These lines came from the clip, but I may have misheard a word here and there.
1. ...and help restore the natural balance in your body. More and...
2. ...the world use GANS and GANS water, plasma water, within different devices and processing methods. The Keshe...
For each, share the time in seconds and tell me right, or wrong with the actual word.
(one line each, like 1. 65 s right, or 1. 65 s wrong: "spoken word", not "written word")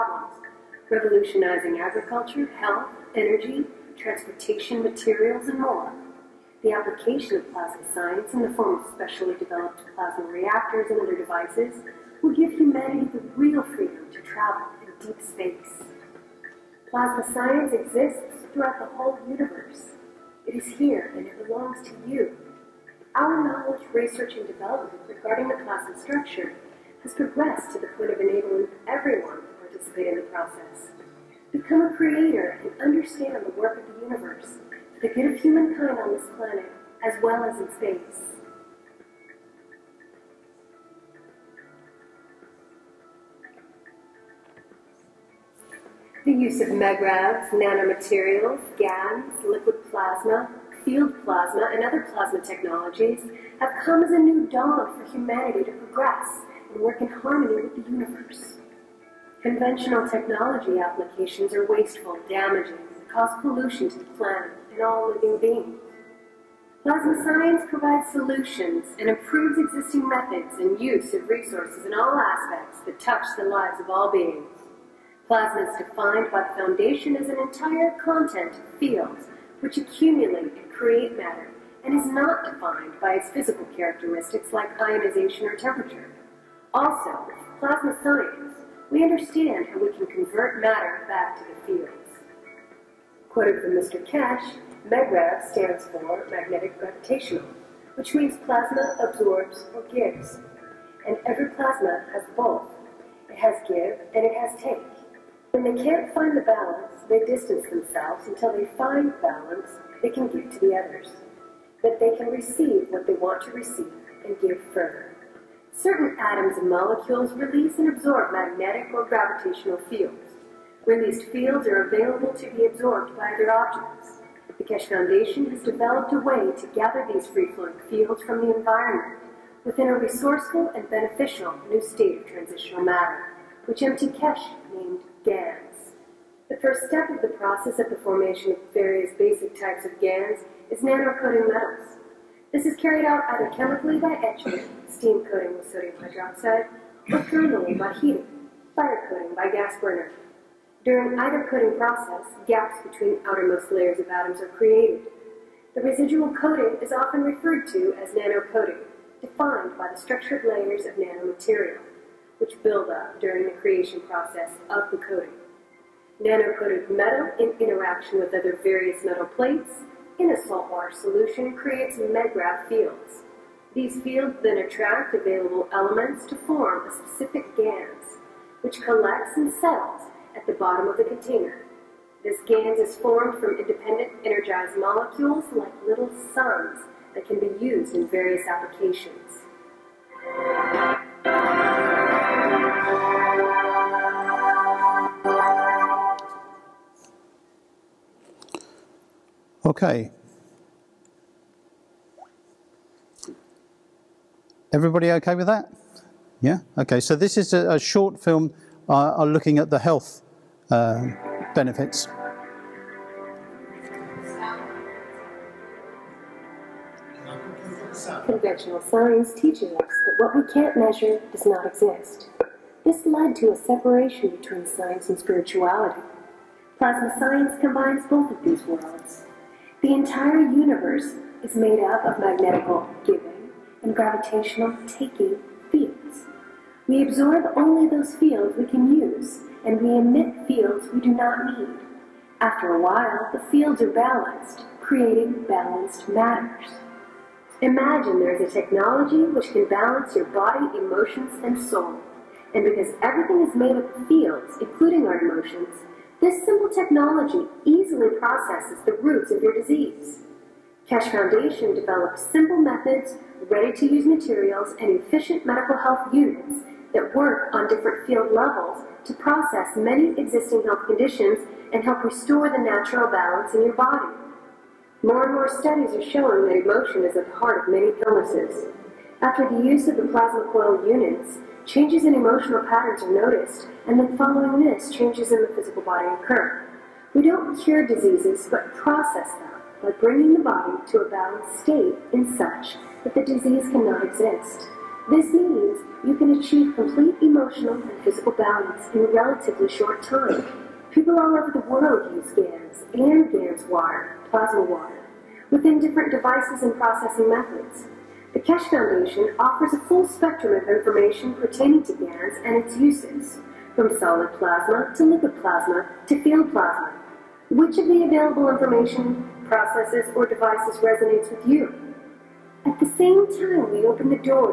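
1. 271 s right
2. 301 s right.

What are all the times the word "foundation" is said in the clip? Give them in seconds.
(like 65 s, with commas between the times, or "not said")
76 s, 124 s, 261 s, 308 s.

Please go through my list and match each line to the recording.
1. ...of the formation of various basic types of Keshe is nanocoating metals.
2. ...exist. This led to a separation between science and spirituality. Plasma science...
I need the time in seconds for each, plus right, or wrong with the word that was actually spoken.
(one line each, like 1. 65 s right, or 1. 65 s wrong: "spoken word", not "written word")
1. 137 s wrong: "GANs", not "Keshe"
2. 221 s right.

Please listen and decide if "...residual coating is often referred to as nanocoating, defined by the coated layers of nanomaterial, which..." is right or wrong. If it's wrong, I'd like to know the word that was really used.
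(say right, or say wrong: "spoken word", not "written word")
wrong: "structured", not "coated".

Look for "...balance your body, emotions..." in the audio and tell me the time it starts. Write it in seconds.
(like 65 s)
249 s.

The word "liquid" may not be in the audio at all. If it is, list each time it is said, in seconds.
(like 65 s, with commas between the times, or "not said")
49 s, 315 s.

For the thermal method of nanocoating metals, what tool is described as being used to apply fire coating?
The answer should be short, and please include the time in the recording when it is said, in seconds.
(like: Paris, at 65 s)
gas burner, at 149 s.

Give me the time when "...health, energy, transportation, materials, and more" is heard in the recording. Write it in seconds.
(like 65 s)
2 s.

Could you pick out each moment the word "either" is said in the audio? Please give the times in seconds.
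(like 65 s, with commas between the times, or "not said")
143 s, 151 s.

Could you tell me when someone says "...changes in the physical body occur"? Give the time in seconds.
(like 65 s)
284 s.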